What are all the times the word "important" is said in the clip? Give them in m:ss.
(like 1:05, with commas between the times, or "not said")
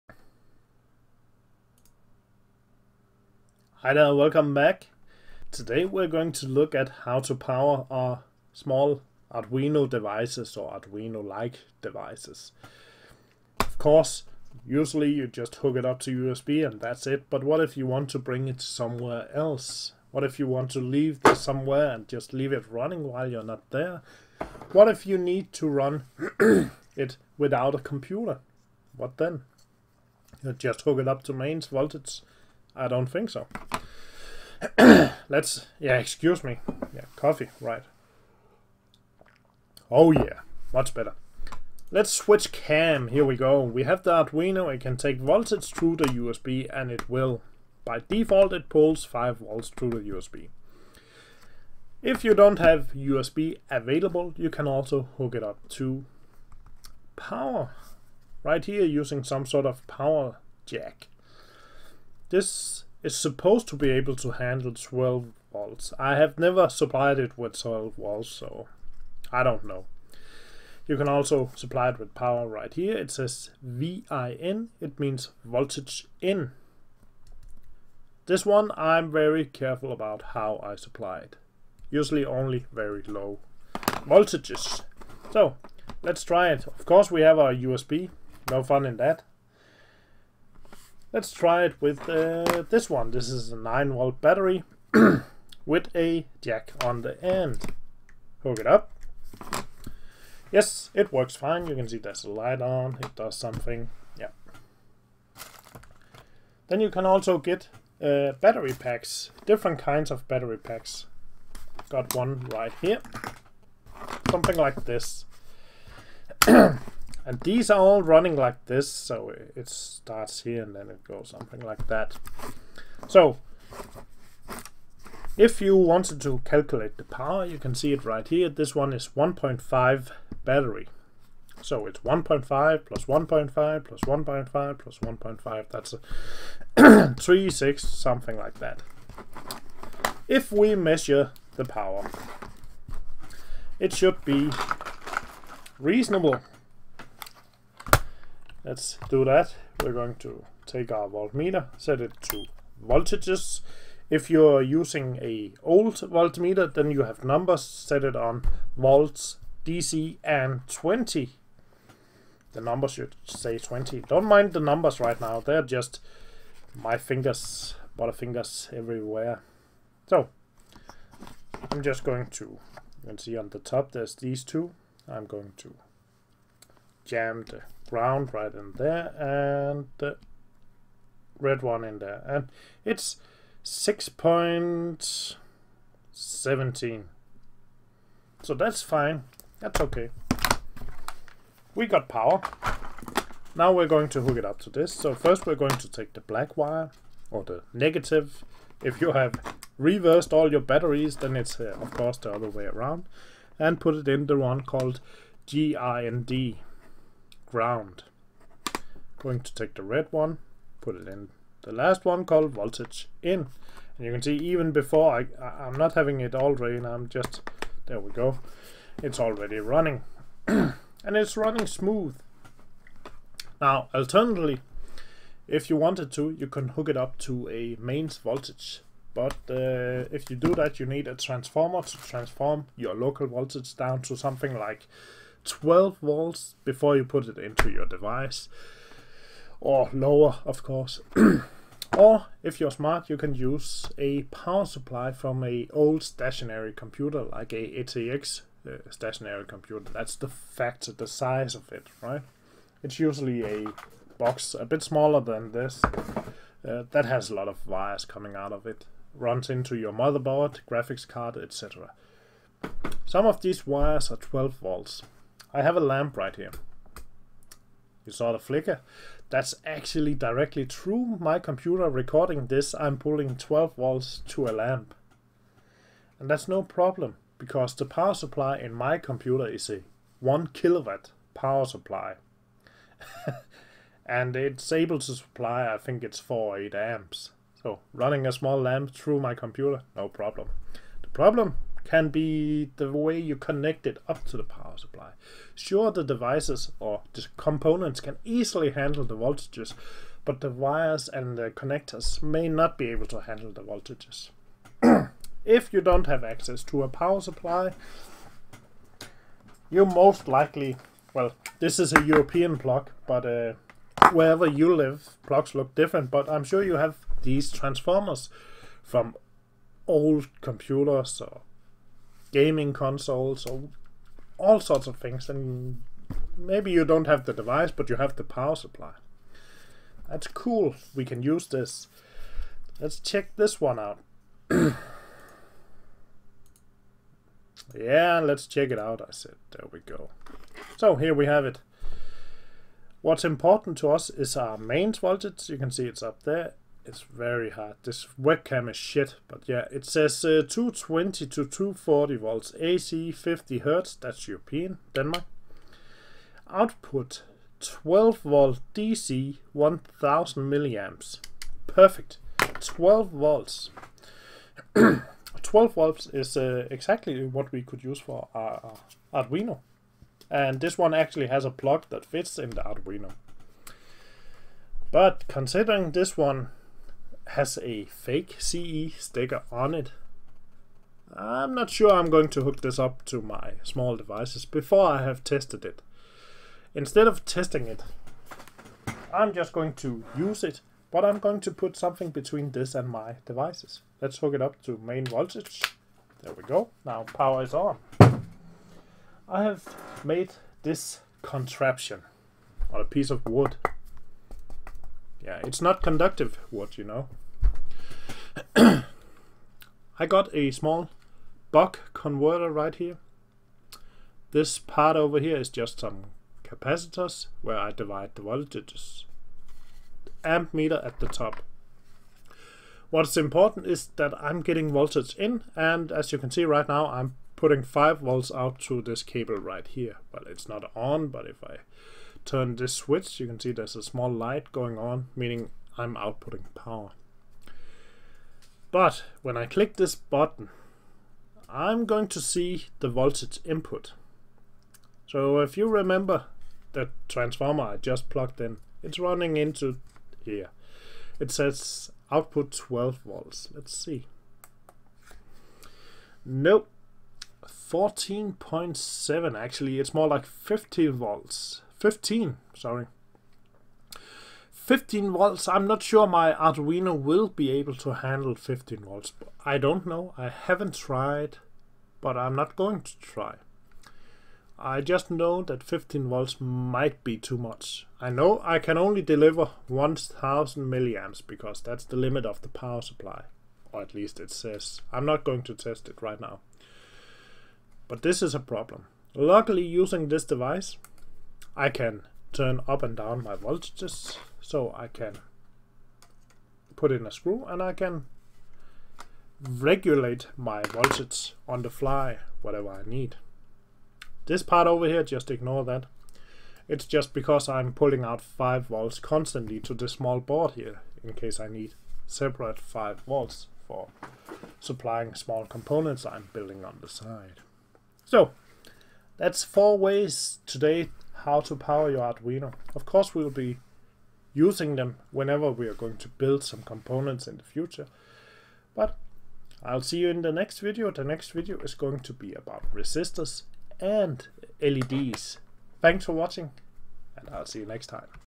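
5:43, 7:03.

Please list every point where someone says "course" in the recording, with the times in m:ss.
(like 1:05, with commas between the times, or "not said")
0:13, 1:26, 3:21, 4:00, 8:42.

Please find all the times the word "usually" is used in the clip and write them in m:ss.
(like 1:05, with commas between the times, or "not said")
0:14, 1:21, 4:12.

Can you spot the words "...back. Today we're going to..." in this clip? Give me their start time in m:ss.
0:04.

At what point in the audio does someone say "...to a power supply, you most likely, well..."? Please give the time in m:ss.
5:06.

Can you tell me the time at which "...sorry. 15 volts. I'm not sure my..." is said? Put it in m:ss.
7:42.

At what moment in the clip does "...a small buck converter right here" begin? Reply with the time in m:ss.
6:50.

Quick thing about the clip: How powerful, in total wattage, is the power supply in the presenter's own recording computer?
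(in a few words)
1 kilowatt.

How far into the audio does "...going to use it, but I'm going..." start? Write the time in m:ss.
6:29.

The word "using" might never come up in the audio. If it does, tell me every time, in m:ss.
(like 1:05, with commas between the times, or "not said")
0:58, 2:34, 8:09, 8:44.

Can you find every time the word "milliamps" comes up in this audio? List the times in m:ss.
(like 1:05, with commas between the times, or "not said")
6:00, 8:00.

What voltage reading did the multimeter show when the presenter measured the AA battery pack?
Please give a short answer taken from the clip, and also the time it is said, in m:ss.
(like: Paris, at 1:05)
6.17, at 3:03.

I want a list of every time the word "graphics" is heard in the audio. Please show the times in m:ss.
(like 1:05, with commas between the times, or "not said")
4:20.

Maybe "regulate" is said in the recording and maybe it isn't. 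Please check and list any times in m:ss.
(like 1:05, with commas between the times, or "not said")
8:19.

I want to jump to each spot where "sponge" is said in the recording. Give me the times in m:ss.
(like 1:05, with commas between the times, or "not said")
not said.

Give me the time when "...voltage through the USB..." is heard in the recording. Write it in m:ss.
0:45.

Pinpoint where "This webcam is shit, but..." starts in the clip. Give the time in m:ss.
5:47.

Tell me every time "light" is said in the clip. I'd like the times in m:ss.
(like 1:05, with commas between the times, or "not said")
1:42, 7:14.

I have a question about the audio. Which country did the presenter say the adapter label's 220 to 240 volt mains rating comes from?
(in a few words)
Denmark.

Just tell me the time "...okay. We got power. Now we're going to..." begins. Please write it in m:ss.
3:09.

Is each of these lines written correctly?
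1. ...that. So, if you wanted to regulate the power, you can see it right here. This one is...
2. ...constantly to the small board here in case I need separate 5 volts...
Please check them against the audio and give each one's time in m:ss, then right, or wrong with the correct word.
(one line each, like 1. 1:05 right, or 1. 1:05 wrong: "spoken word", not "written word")
1. 2:01 wrong: "calculate", not "regulate"
2. 8:28 right.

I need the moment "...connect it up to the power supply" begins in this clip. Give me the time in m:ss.
4:53.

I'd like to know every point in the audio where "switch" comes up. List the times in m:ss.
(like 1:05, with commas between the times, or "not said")
0:42, 7:12.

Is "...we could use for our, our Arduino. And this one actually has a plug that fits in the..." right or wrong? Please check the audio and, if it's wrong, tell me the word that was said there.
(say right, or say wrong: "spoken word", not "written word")
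right.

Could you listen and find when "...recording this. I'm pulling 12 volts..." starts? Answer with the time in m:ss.
4:31.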